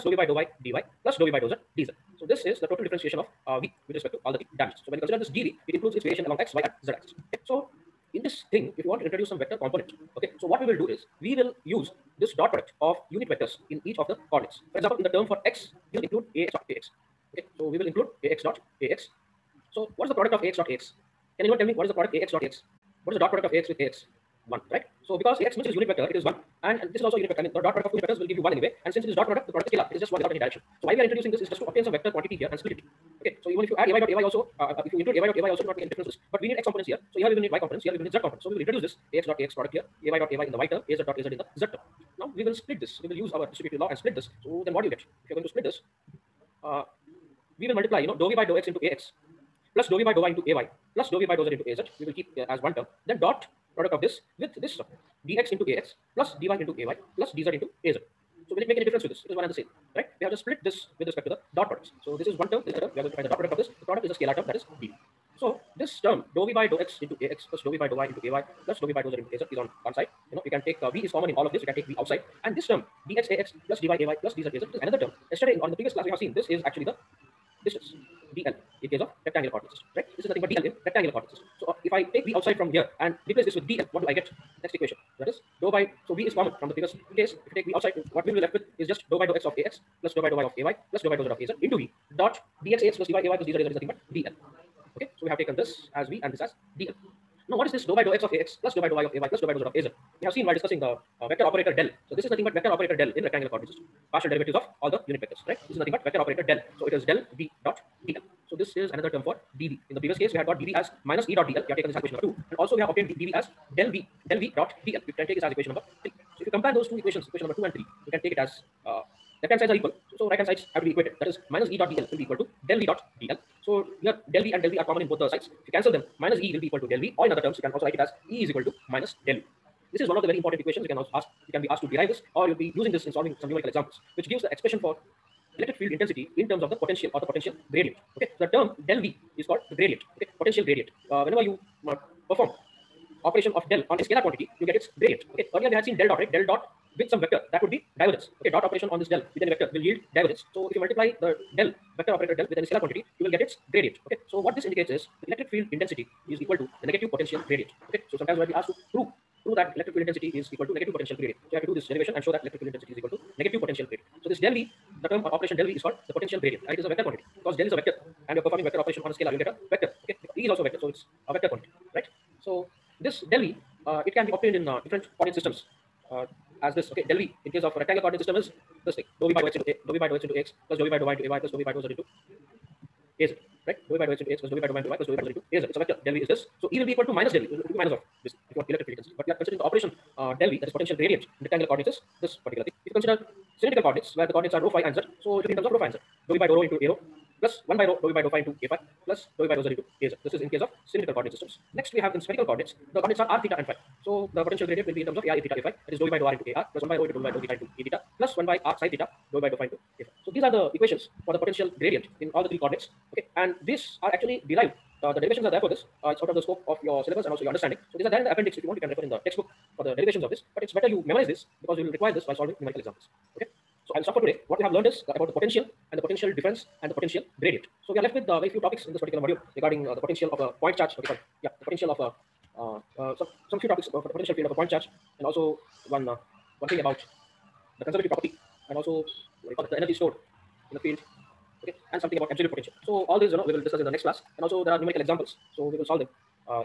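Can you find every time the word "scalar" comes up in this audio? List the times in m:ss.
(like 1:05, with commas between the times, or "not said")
0:29, 1:04, 2:24, 2:32, 2:49.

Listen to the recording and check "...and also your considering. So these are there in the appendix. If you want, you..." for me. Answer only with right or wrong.
wrong.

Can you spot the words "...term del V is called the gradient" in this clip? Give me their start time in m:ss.
2:18.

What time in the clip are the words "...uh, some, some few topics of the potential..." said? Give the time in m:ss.
3:52.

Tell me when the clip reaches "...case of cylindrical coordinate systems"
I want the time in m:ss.
3:20.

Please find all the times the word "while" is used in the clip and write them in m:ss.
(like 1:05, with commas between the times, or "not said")
1:40, 3:42.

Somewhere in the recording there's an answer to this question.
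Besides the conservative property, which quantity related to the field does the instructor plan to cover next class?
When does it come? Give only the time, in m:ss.
3:59.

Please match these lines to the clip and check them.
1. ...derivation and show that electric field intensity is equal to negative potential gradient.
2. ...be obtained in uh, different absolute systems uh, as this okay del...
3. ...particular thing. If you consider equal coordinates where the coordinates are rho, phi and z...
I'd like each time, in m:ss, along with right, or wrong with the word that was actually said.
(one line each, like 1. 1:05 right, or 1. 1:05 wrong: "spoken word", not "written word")
1. 2:41 right
2. 2:54 wrong: "coordinate", not "absolute"
3. 3:12 wrong: "cylindrical", not "equal".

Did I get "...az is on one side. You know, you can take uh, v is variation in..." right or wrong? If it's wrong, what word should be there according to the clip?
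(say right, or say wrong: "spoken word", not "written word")
wrong: "common", not "variation".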